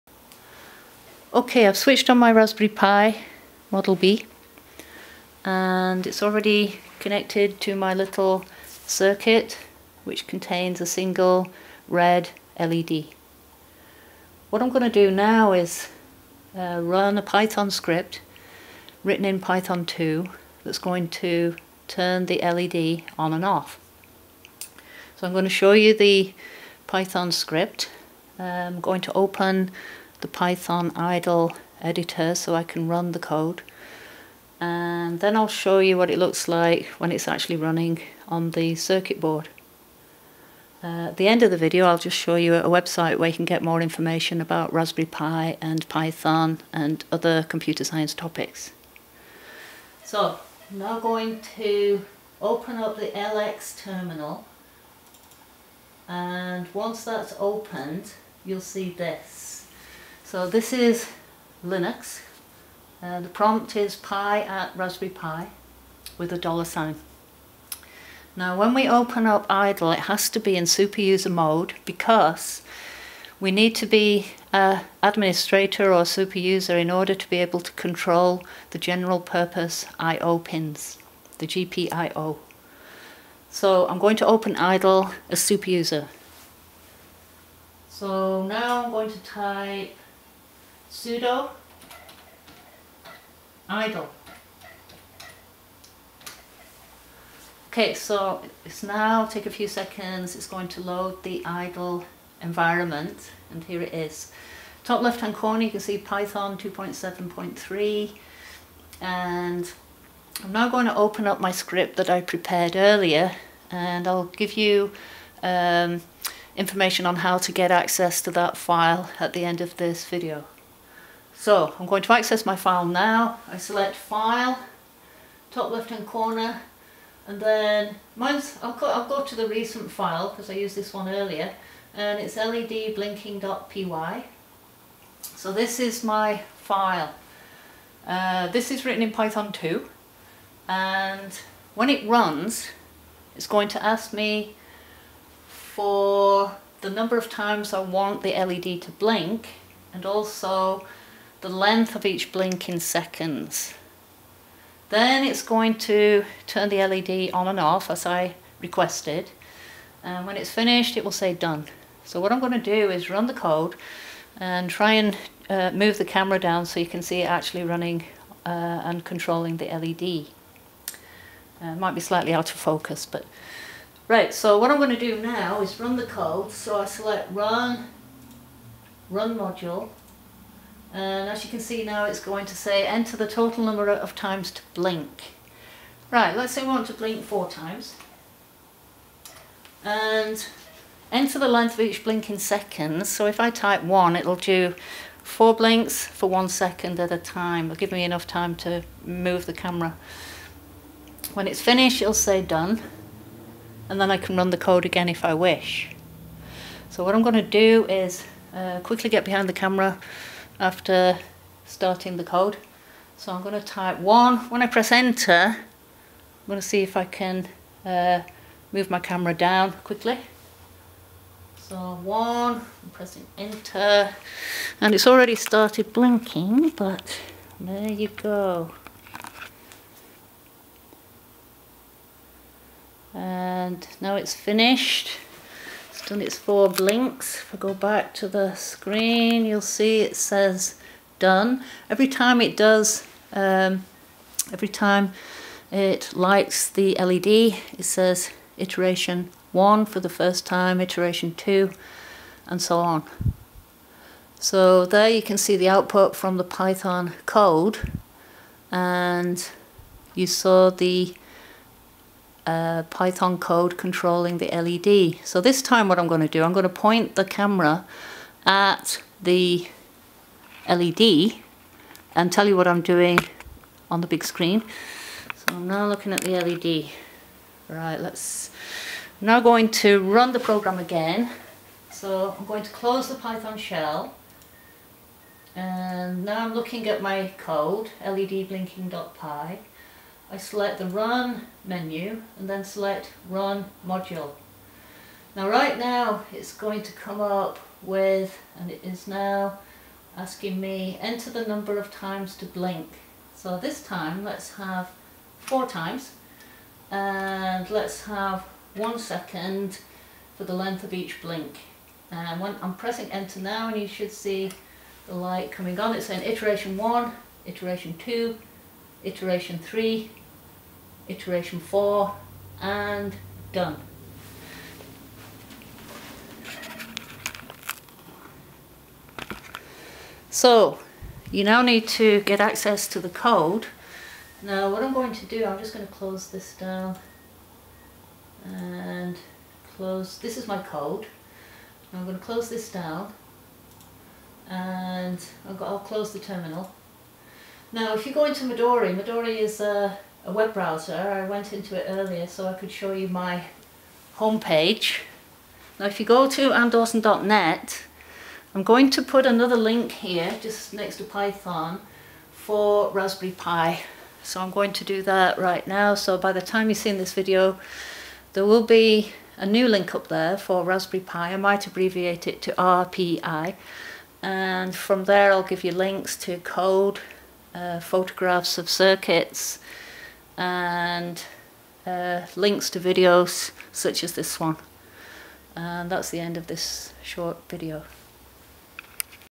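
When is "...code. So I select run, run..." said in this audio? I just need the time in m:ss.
2:56.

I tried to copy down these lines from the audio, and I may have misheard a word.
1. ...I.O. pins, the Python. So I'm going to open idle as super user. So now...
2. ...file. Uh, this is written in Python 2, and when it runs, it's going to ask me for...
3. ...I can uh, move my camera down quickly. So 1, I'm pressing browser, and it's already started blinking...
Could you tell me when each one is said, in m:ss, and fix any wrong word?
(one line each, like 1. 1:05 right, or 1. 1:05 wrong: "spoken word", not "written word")
1. 1:19 wrong: "GPIO", not "Python"
2. 2:16 right
3. 3:36 wrong: "enter", not "browser".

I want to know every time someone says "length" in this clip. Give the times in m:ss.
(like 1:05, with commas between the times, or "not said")
2:31, 3:11, 5:10.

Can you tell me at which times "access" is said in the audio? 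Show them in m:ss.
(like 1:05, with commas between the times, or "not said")
1:57, 2:02, 5:32.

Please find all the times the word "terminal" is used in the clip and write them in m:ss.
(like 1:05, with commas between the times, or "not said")
0:53, 5:46.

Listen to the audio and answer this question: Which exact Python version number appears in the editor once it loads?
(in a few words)
2.7.3.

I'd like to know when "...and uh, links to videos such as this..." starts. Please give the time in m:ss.
6:20.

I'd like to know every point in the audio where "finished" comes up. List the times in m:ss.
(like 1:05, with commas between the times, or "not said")
2:40, 3:21, 3:54.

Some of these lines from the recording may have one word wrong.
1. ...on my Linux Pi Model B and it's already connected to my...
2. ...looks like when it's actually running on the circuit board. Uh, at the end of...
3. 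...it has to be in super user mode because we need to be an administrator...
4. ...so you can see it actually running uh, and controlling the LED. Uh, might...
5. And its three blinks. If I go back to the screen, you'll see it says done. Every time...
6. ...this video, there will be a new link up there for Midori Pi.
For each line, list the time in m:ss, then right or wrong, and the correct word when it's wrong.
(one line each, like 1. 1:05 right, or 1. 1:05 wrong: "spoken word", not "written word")
1. 0:02 wrong: "Raspberry", not "Linux"
2. 0:36 right
3. 1:09 right
4. 2:46 right
5. 3:56 wrong: "four", not "three"
6. 6:06 wrong: "Raspberry", not "Midori".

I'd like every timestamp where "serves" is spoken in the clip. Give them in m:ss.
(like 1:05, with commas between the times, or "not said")
not said.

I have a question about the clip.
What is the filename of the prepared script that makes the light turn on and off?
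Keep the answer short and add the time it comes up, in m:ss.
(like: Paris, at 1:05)
ledblinking.py, at 2:12.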